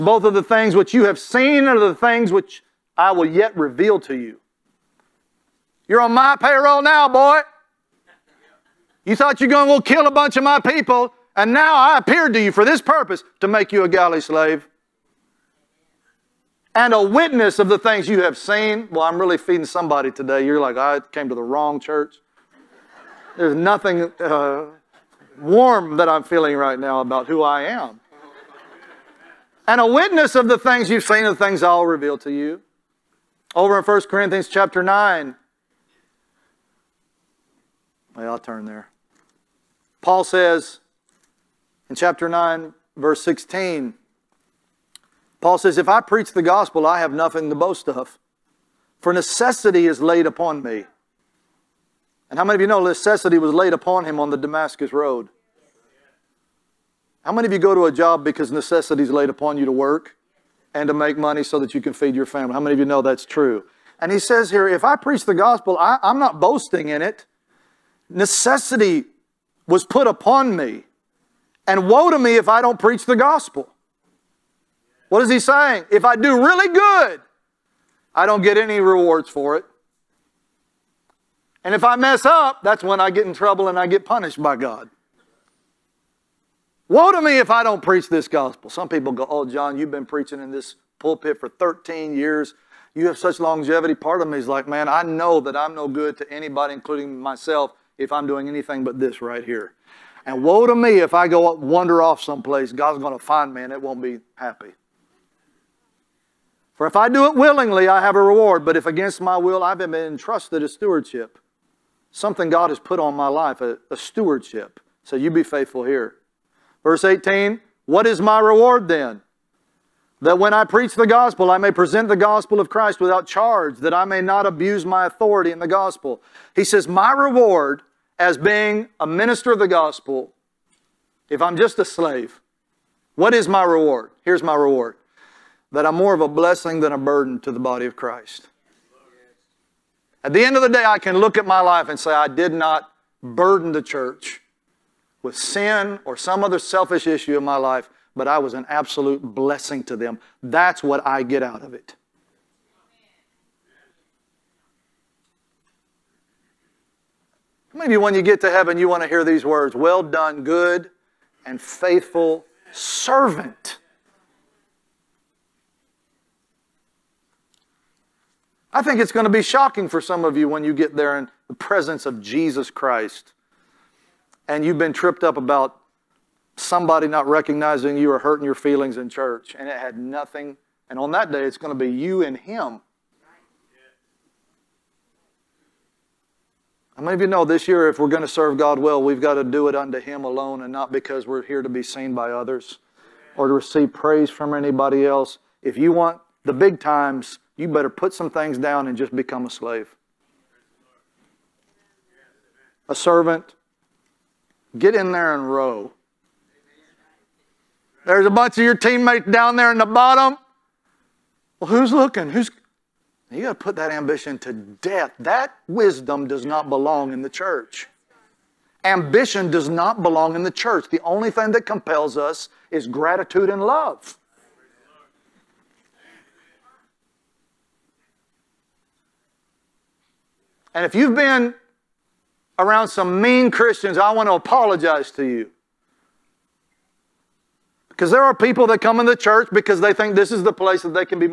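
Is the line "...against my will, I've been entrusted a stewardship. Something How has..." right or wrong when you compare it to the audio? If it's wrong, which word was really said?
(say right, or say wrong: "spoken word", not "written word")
wrong: "God", not "How".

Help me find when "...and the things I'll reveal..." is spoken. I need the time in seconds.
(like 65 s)
31 s.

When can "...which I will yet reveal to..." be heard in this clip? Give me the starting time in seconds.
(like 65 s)
2 s.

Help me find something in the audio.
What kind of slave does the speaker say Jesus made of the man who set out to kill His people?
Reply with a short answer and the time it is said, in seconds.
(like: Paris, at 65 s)
Galley slave, at 13 s.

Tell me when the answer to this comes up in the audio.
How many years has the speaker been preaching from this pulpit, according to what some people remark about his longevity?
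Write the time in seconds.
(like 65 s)
91 s.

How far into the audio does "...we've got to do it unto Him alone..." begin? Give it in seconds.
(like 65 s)
189 s.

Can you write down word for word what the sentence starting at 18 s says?
Well, I'm really feeding somebody today.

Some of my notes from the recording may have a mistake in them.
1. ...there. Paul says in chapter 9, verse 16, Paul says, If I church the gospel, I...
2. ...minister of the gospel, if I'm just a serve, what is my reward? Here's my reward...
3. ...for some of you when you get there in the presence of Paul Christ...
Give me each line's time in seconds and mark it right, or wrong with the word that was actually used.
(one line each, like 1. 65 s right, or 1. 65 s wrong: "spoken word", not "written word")
1. 38 s wrong: "preach", not "church"
2. 129 s wrong: "slave", not "serve"
3. 169 s wrong: "Jesus", not "Paul".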